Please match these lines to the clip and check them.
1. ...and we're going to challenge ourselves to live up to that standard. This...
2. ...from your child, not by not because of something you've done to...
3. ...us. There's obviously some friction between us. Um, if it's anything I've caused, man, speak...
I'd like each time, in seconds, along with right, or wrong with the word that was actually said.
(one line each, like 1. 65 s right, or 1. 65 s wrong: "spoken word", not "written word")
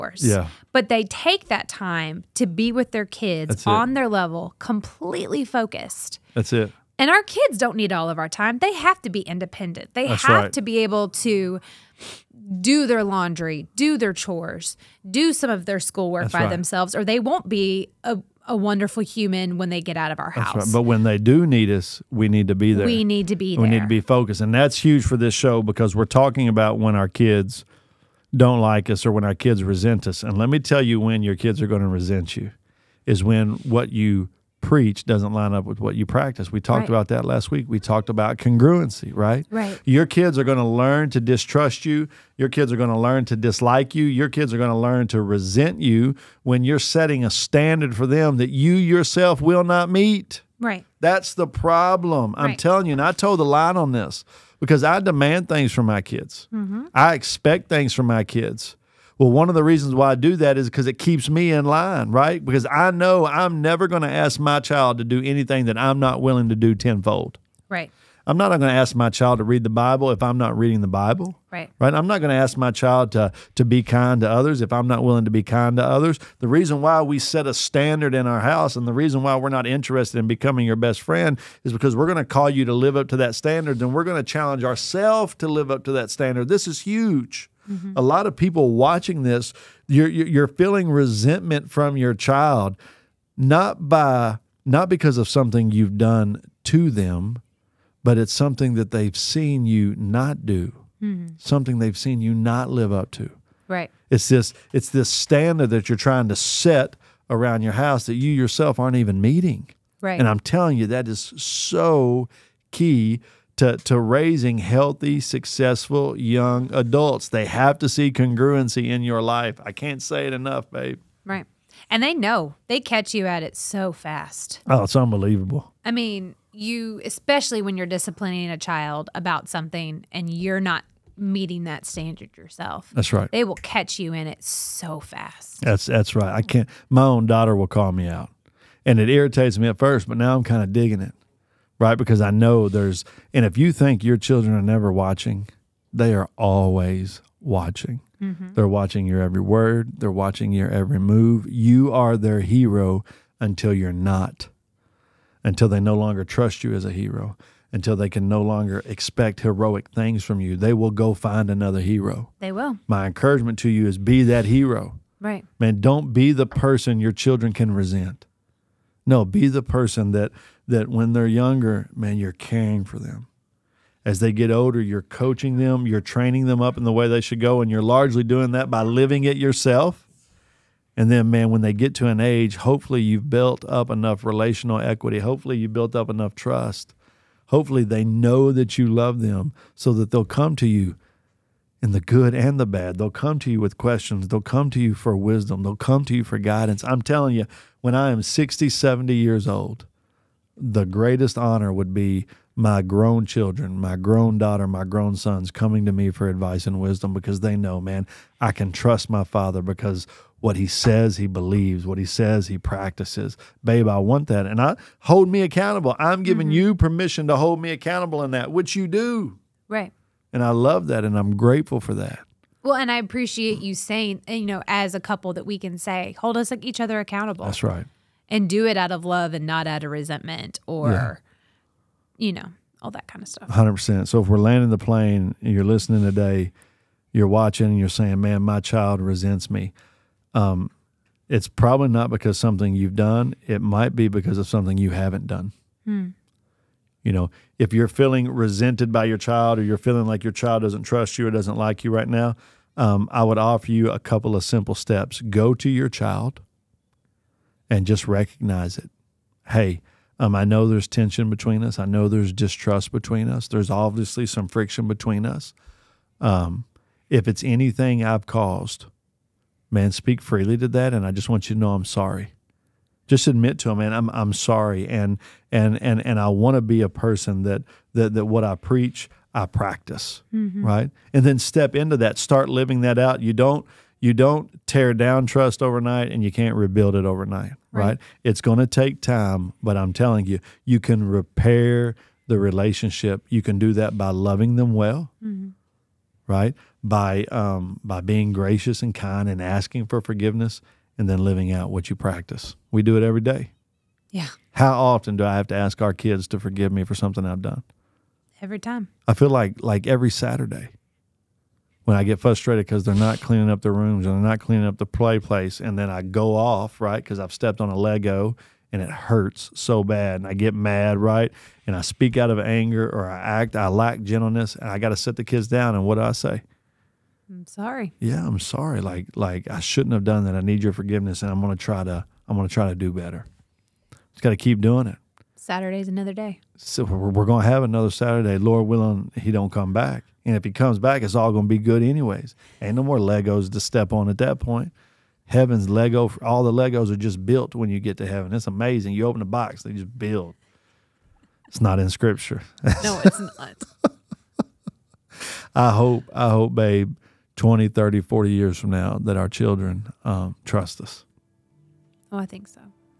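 1. 83 s right
2. 91 s right
3. 263 s right.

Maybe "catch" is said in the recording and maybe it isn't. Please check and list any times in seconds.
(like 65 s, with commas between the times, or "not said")
122 s, 133 s.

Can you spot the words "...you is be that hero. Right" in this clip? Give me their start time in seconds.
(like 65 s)
163 s.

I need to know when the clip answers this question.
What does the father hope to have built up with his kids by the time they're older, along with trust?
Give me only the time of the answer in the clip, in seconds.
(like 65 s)
184 s.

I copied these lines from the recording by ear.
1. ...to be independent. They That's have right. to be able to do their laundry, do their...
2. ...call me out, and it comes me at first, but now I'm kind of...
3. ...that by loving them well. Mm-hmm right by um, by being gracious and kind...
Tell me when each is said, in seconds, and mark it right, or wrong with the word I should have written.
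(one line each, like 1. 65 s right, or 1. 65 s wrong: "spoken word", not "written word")
1. 9 s right
2. 137 s wrong: "irritates", not "comes"
3. 293 s right.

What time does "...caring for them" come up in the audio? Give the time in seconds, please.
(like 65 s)
172 s.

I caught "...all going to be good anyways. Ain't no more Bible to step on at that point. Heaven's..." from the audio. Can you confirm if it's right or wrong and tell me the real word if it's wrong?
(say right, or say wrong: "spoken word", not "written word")
wrong: "Legos", not "Bible".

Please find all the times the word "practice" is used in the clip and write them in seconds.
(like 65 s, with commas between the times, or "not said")
36 s, 212 s, 279 s, 301 s.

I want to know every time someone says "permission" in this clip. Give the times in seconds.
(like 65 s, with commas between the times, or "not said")
216 s.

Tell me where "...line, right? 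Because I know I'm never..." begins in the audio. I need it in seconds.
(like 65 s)
61 s.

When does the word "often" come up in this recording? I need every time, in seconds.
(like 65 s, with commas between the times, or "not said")
304 s.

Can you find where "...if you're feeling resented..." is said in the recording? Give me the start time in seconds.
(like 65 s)
247 s.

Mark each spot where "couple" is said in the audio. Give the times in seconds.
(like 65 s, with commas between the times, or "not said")
224 s, 253 s.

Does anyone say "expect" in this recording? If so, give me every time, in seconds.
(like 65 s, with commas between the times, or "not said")
57 s, 158 s.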